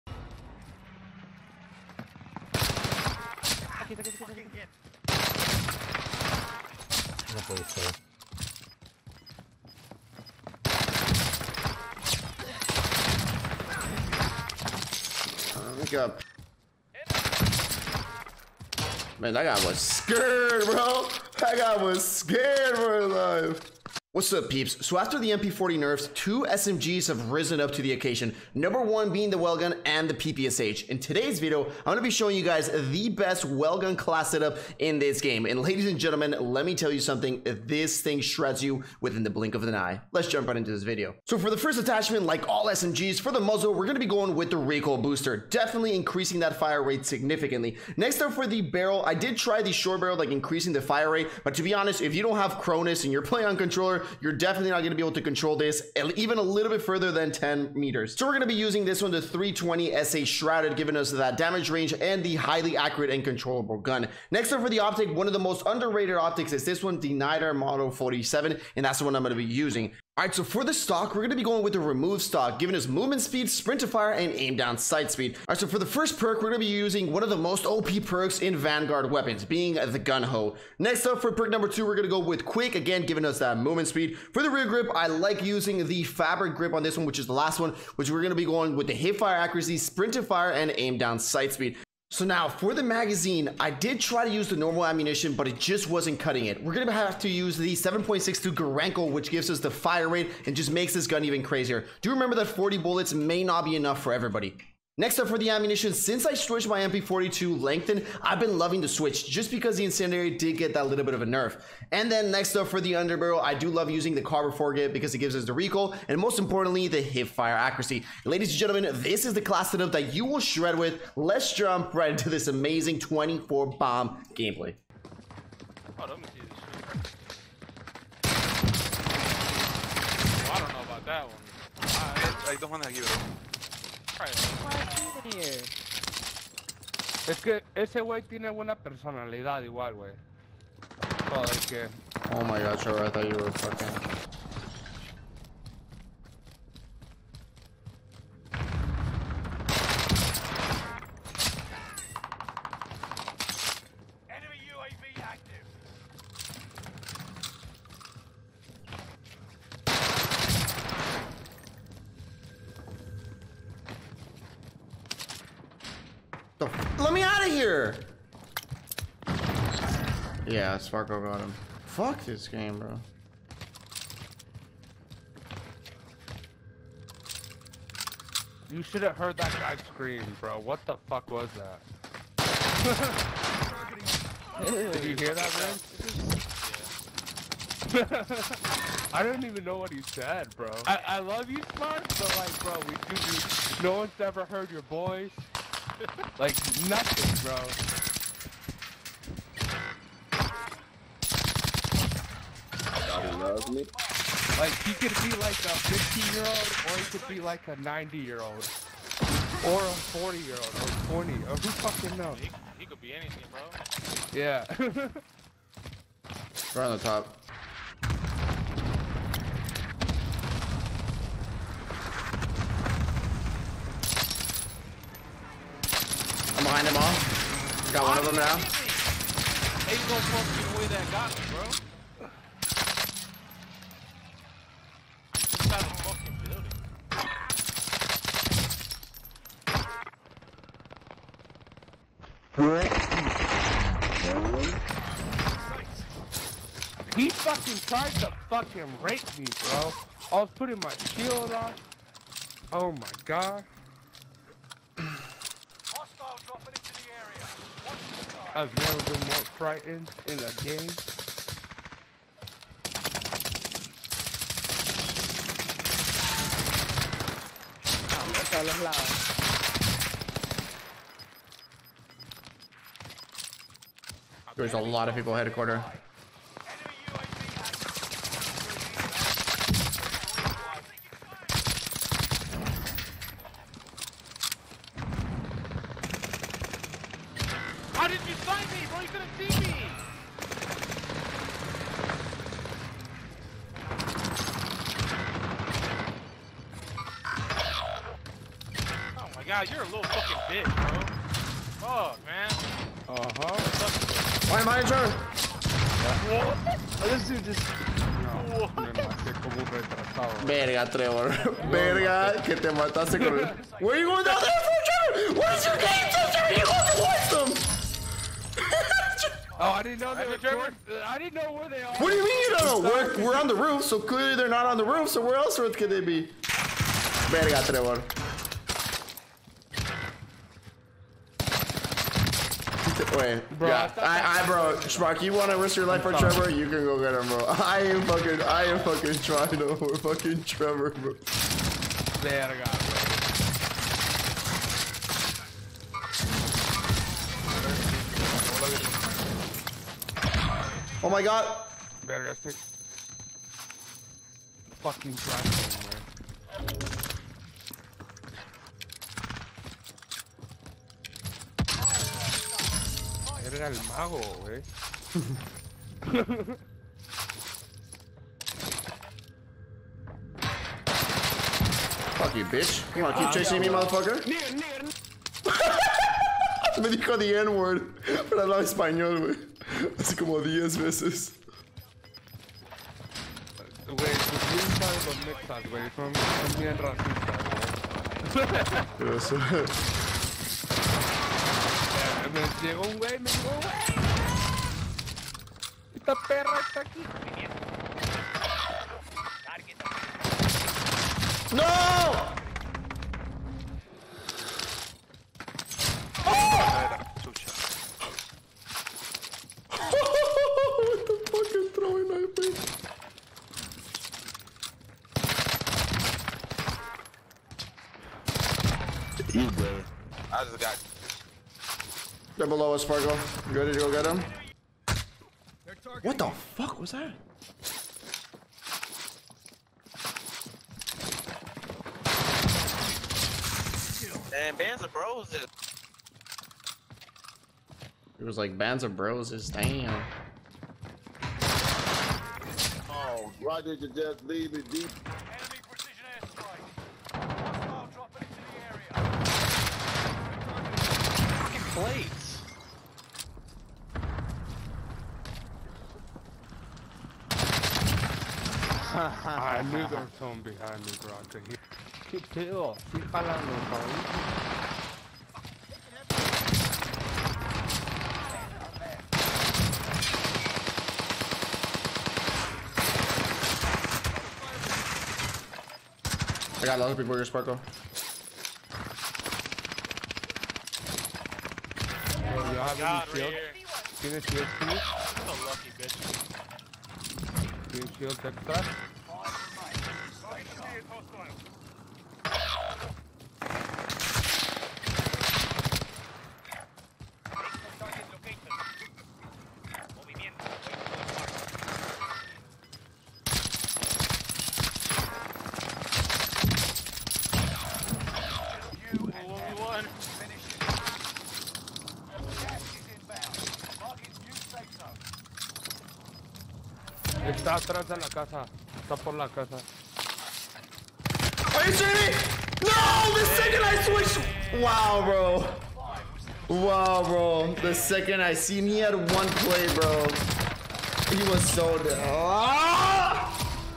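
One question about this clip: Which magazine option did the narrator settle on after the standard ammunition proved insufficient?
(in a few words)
7.62 Gorenko.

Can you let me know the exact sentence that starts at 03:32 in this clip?
He, he could be anything, bro.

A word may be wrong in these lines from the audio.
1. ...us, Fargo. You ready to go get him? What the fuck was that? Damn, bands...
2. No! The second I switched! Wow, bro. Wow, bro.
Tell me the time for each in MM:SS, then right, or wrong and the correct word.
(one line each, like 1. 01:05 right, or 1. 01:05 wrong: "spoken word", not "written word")
1. 07:02 right
2. 08:42 right.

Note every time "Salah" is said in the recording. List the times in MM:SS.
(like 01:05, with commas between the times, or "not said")
04:28.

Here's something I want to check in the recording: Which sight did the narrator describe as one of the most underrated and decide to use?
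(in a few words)
Nydar Model 47.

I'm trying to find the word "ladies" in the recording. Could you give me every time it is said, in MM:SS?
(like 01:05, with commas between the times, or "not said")
00:35, 01:58.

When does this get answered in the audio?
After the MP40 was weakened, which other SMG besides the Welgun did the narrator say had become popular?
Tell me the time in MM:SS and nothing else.
00:30.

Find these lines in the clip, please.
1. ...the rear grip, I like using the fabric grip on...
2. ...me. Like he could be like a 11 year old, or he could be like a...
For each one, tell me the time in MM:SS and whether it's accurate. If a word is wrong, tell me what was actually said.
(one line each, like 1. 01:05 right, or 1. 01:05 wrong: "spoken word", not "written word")
1. 01:24 right
2. 03:23 wrong: "15", not "11".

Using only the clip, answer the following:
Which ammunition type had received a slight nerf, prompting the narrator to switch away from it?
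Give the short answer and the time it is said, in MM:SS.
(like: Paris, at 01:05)
Incendiary, at 01:49.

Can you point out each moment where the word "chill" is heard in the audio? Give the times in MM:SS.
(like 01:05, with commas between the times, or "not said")
07:42.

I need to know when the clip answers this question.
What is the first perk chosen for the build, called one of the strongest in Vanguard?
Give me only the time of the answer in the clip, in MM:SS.
01:19.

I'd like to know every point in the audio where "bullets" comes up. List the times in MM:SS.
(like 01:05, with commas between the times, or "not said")
01:42.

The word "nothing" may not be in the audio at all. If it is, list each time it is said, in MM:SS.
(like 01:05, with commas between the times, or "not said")
03:16.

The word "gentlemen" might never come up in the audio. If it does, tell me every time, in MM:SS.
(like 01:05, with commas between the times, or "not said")
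00:35, 01:58.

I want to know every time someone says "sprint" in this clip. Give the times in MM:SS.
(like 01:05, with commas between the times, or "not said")
01:13, 01:29.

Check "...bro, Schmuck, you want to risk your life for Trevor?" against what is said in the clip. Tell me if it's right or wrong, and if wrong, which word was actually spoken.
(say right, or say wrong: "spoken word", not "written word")
right.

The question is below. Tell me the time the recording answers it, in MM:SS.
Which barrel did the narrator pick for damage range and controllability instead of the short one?
00:59.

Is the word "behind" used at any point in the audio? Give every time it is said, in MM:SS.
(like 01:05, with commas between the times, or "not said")
03:46, 07:40.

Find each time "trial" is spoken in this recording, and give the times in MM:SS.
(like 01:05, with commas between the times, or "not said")
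not said.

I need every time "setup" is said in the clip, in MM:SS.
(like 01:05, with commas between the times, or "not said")
00:34, 01:59.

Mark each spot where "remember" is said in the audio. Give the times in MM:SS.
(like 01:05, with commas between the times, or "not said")
01:42.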